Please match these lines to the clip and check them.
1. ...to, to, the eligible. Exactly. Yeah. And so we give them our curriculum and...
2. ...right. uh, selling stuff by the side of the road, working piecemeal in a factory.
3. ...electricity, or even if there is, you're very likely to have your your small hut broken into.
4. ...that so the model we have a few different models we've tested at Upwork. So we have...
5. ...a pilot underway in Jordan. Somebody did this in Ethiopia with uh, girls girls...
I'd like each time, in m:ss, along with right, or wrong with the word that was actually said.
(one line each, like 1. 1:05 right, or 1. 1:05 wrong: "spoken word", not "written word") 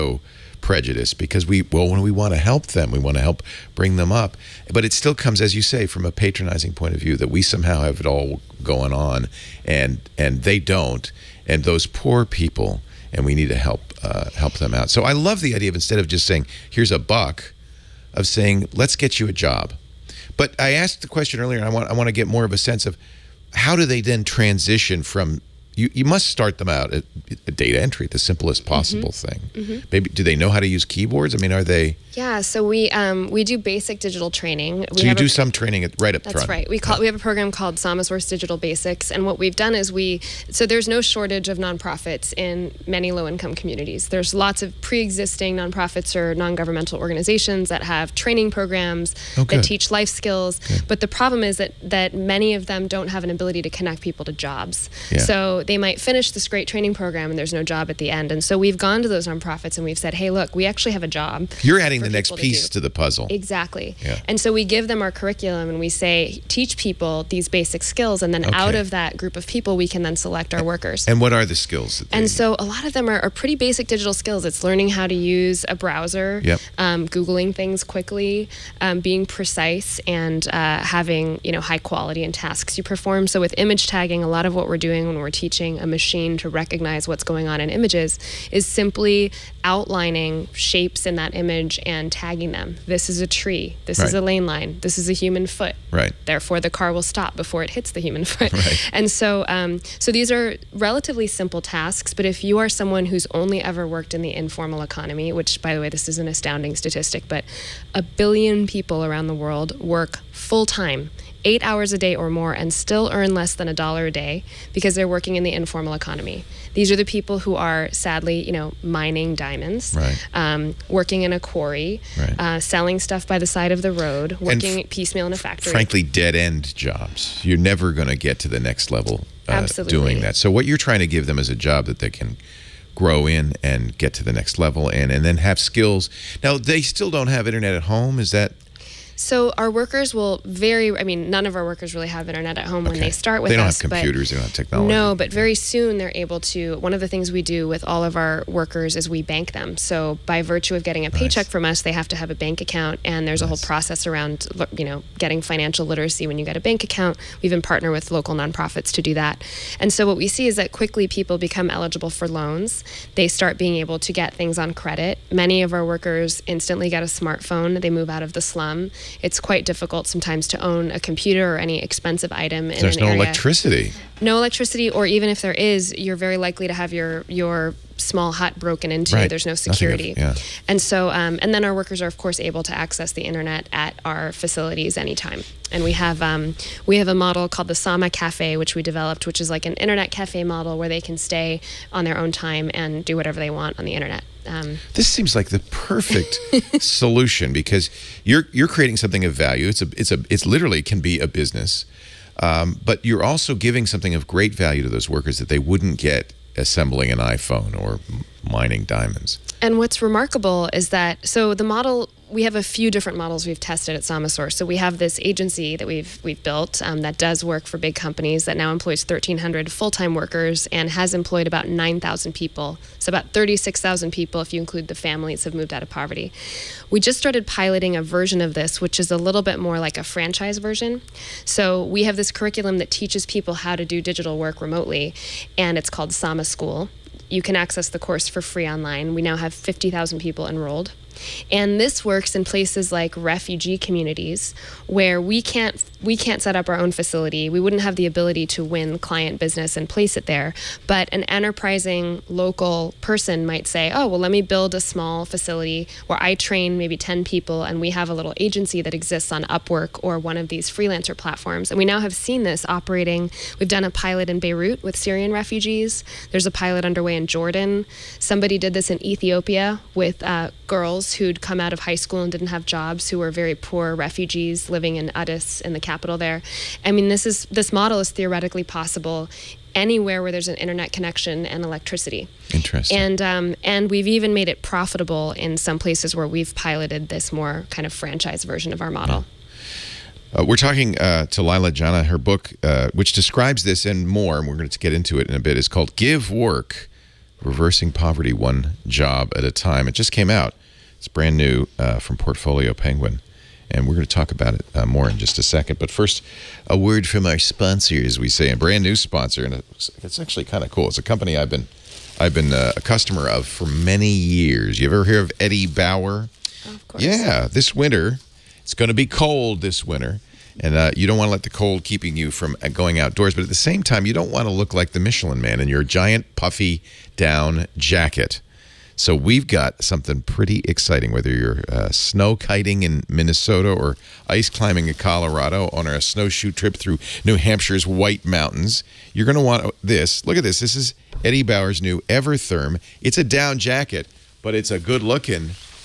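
1. 1:02 wrong: "puzzle", not "eligible"
2. 2:02 right
3. 2:54 right
4. 3:30 wrong: "Samasource", not "Upwork"
5. 4:26 right.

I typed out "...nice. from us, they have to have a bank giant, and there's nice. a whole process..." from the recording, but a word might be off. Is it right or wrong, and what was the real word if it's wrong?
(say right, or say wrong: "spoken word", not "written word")
wrong: "account", not "giant".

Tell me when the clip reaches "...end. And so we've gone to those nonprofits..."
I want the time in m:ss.
0:58.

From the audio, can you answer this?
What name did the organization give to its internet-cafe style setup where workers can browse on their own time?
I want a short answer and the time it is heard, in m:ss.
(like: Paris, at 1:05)
Sama Cafe, at 3:07.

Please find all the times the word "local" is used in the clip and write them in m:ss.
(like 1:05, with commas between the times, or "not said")
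2:38, 4:12.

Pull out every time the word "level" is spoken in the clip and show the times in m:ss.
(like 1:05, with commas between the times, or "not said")
2:08, 2:14.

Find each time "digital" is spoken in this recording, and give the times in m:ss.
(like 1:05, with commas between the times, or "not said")
0:34, 0:38, 1:13, 3:54.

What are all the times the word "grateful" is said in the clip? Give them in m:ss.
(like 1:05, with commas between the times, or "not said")
not said.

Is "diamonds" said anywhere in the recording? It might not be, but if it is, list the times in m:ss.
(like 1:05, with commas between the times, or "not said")
1:59, 3:28.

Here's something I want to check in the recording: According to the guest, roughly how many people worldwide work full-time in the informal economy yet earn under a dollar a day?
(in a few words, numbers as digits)
a billion.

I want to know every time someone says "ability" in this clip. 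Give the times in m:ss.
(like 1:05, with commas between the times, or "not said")
0:53, 4:08.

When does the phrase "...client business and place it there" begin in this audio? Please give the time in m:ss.
4:08.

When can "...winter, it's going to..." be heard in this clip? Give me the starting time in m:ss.
5:17.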